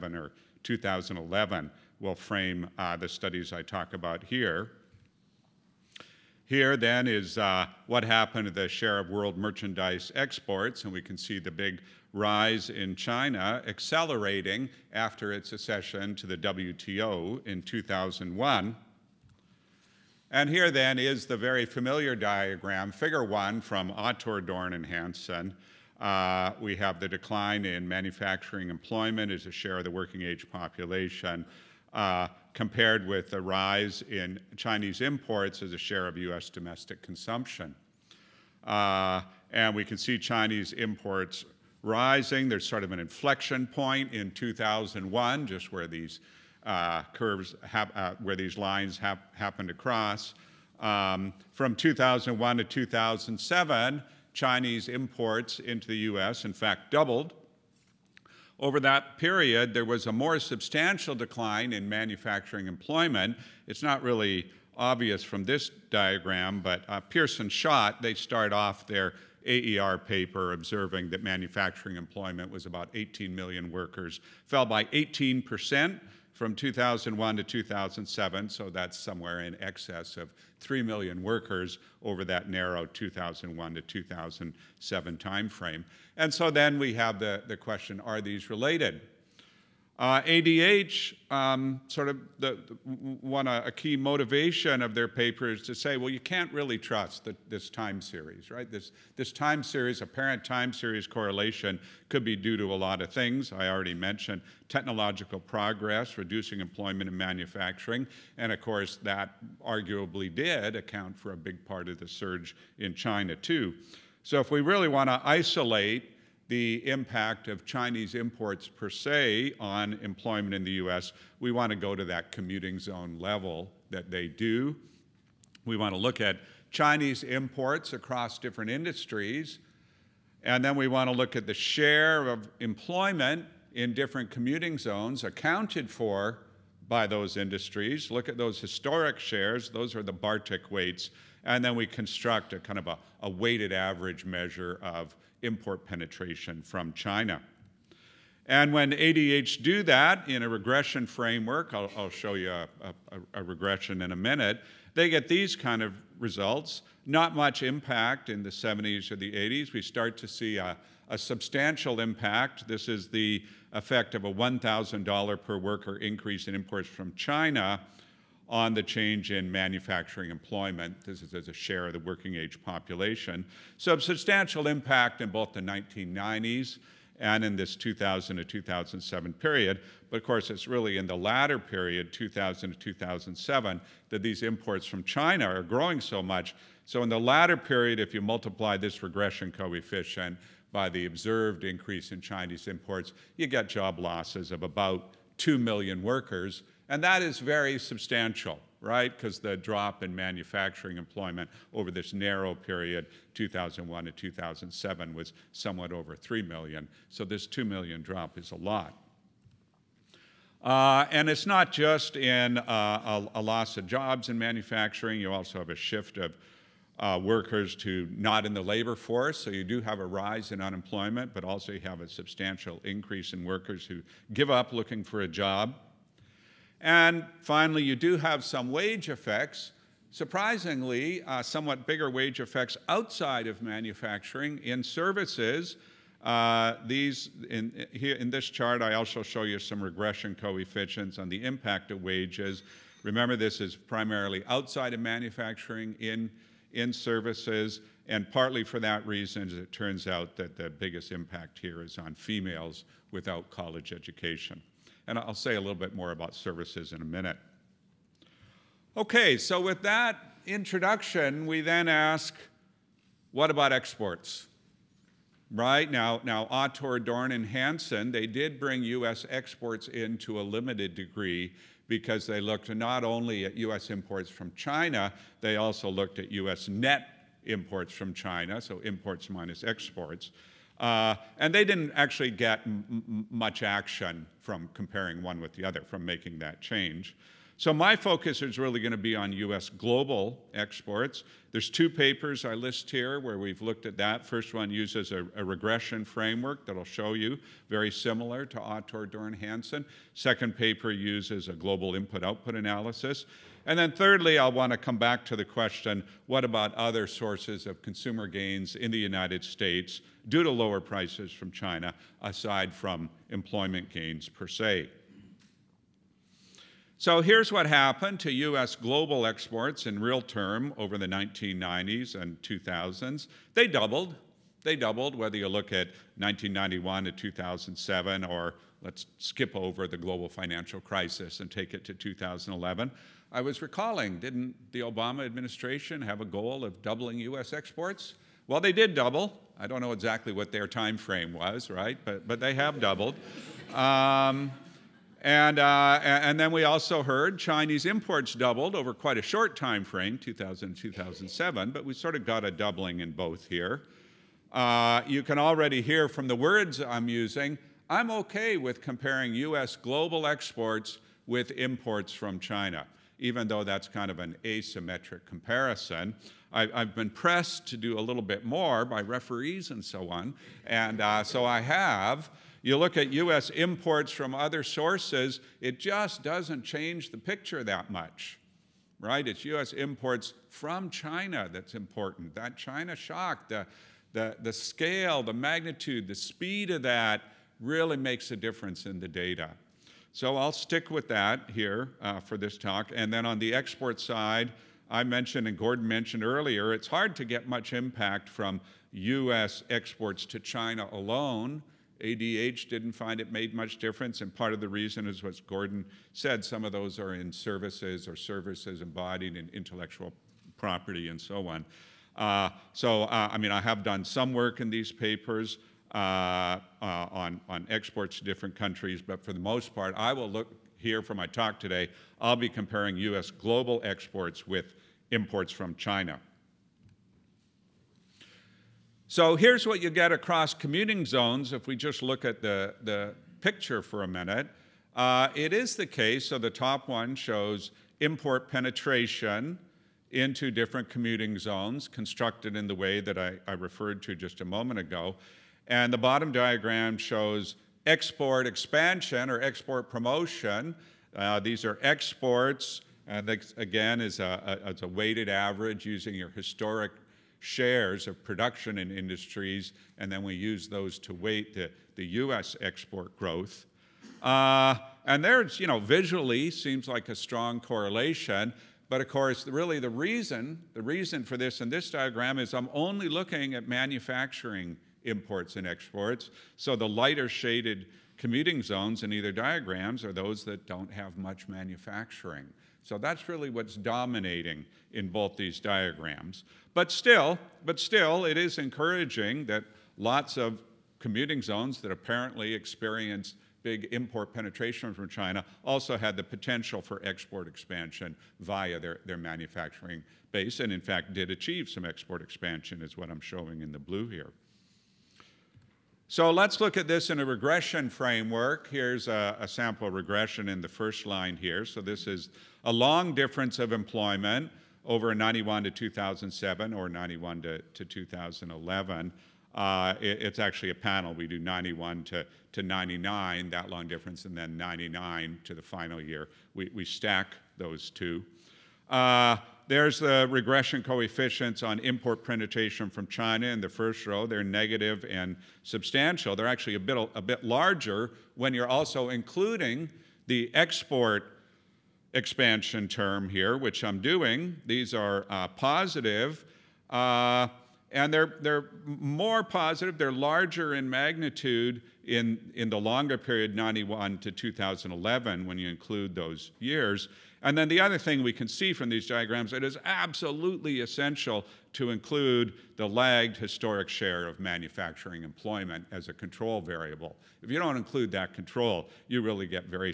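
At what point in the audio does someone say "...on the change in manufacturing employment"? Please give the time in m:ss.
2:48.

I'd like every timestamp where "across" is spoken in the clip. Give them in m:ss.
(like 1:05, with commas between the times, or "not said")
2:07, 7:10.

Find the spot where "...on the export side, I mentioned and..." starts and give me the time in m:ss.
6:33.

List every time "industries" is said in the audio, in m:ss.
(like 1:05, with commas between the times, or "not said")
2:08, 2:17, 7:38.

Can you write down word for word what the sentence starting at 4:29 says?
exports in to a limited degree because they looked not only at U.S.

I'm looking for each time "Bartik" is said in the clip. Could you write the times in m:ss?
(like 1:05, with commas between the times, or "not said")
2:20.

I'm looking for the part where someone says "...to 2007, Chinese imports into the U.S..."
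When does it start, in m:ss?
0:52.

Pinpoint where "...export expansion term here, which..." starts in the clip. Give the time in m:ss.
9:00.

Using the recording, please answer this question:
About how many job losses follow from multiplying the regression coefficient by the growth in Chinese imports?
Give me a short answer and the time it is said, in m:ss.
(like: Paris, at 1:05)
2 million, at 3:15.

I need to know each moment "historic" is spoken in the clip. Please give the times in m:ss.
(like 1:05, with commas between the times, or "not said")
2:18, 7:36, 9:23.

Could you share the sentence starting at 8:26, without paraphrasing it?
So let's look at this in a regression framework.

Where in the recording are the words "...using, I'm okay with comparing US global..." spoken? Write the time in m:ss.
5:57.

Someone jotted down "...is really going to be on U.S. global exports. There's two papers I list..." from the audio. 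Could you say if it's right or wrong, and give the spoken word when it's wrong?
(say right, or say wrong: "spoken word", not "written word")
right.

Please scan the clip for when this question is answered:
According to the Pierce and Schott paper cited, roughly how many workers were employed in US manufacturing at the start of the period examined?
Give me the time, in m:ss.
1:12.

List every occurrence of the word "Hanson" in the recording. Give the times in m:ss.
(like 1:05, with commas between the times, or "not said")
0:24, 4:27, 4:59.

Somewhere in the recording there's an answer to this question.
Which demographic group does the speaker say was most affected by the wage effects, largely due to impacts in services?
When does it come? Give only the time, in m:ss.
4:12.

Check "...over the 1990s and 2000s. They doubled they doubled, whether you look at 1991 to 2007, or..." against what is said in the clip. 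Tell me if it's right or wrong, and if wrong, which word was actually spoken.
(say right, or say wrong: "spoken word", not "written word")
right.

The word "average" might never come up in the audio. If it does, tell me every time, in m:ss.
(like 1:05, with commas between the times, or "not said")
2:23, 7:35.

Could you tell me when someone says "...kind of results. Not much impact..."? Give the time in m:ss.
2:35.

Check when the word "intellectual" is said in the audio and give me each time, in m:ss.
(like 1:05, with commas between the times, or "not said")
6:49.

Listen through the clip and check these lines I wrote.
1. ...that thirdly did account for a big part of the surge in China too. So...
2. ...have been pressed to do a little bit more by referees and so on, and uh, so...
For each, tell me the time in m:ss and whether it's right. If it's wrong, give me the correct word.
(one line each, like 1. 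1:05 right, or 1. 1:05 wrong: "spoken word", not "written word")
1. 1:49 wrong: "arguably", not "thirdly"
2. 6:06 right.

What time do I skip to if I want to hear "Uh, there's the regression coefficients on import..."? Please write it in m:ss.
8:48.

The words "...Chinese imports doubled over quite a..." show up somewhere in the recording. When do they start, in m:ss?
5:47.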